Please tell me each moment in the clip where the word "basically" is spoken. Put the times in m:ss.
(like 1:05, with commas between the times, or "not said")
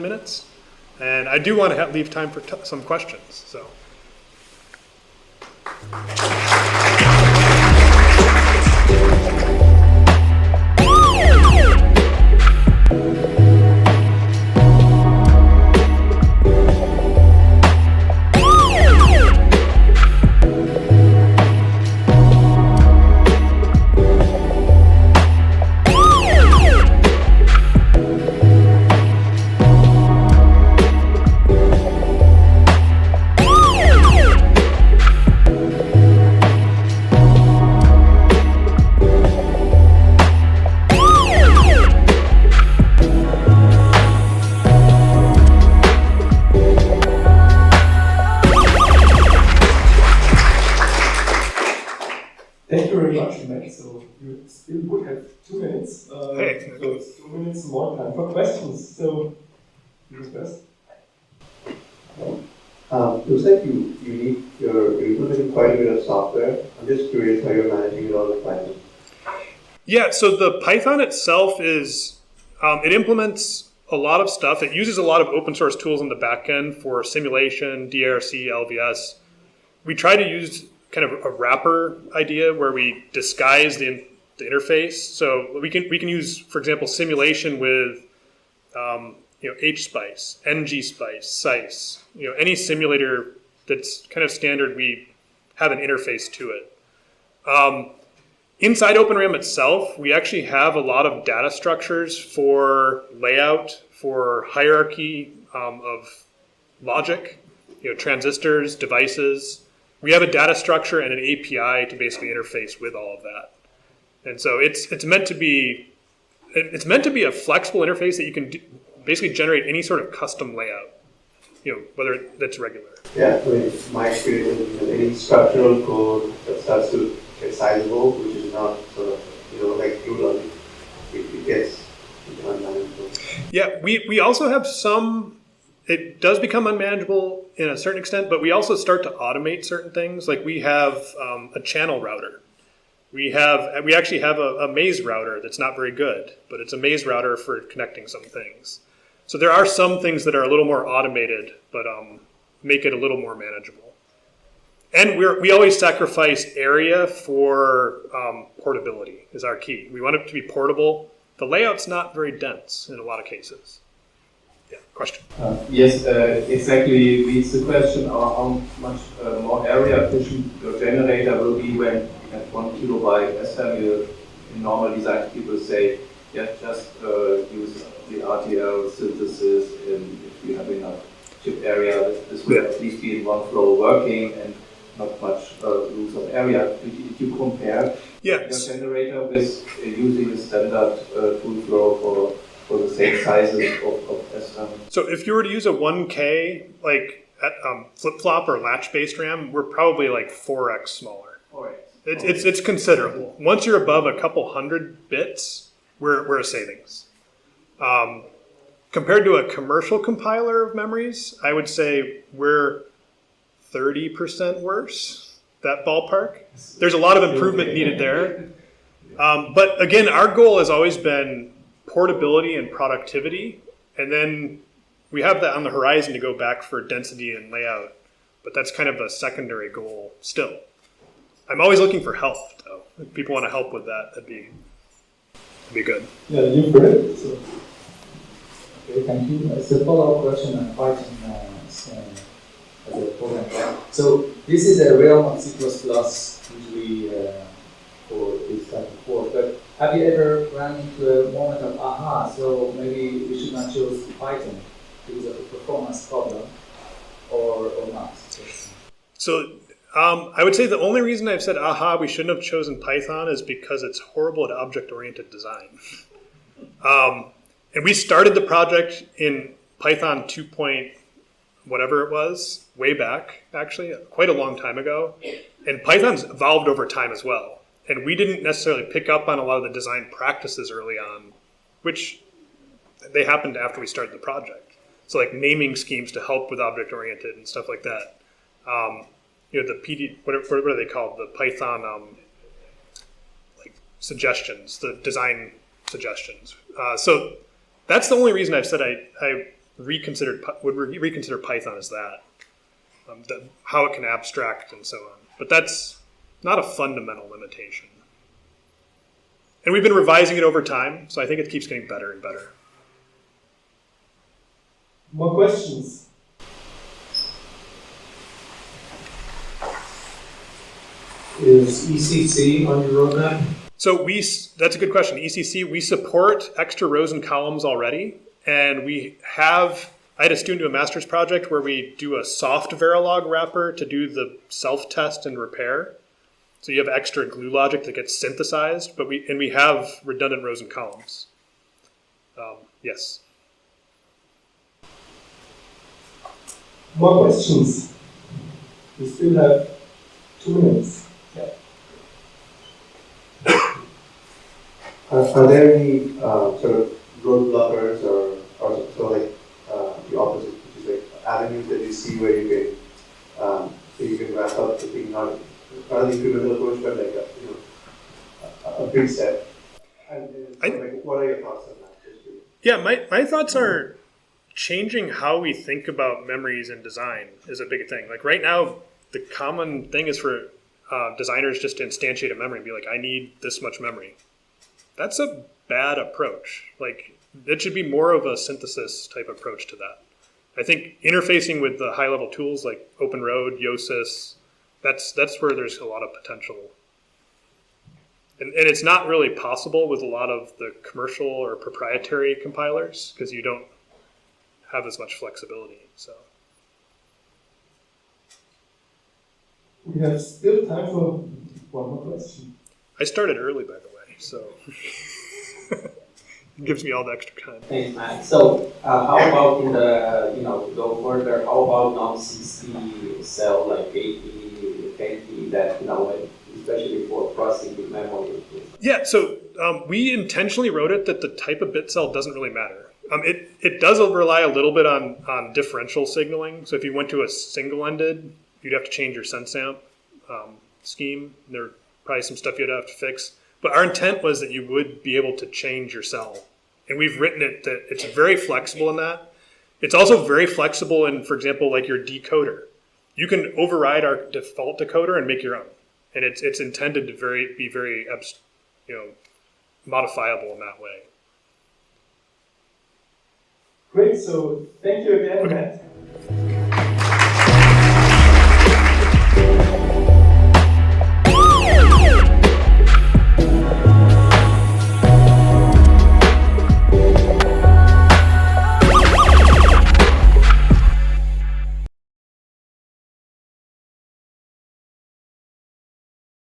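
1:51, 1:59.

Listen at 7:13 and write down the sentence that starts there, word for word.
Um, it, it does rely a little bit on, on differential signaling.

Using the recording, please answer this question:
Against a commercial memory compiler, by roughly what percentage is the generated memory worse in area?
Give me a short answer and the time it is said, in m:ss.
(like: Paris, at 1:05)
30%, at 3:33.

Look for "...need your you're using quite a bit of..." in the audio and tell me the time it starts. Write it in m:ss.
1:04.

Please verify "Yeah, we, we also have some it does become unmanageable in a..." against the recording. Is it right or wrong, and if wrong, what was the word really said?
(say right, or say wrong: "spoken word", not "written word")
right.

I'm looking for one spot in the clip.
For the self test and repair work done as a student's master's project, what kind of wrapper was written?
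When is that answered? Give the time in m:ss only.
5:32.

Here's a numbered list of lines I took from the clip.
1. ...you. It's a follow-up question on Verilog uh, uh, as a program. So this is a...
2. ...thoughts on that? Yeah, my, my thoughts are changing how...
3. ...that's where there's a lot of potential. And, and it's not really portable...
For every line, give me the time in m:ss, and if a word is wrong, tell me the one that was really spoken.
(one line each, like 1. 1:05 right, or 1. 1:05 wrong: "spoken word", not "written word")
1. 3:59 wrong: "Python", not "Verilog"
2. 6:11 right
3. 6:35 wrong: "possible", not "portable".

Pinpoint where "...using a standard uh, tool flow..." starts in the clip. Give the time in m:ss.
3:09.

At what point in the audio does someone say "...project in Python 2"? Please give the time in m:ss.
4:28.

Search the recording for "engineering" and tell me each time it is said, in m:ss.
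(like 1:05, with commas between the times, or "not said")
not said.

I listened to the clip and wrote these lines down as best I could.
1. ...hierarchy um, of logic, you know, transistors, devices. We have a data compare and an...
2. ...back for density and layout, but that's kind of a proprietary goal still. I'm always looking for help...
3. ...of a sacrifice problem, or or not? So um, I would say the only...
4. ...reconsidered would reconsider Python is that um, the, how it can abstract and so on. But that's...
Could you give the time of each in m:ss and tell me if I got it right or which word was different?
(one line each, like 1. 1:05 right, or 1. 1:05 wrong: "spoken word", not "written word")
1. 1:44 wrong: "structure", not "compare"
2. 3:46 wrong: "secondary", not "proprietary"
3. 4:15 wrong: "performance", not "sacrifice"
4. 4:59 right.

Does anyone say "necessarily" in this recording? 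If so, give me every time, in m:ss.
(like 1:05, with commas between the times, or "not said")
4:38.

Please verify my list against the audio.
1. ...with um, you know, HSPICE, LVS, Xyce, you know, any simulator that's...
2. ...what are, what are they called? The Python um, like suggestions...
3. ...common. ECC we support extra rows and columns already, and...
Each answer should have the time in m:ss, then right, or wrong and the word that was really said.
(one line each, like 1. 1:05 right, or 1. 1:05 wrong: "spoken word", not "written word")
1. 1:27 wrong: "NGSPICE", not "LVS"
2. 4:50 right
3. 5:24 wrong: "question", not "common".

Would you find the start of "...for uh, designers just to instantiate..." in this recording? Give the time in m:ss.
6:20.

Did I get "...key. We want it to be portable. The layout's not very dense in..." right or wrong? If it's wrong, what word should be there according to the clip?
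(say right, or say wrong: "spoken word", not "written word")
right.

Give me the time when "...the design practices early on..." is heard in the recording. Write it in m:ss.
4:39.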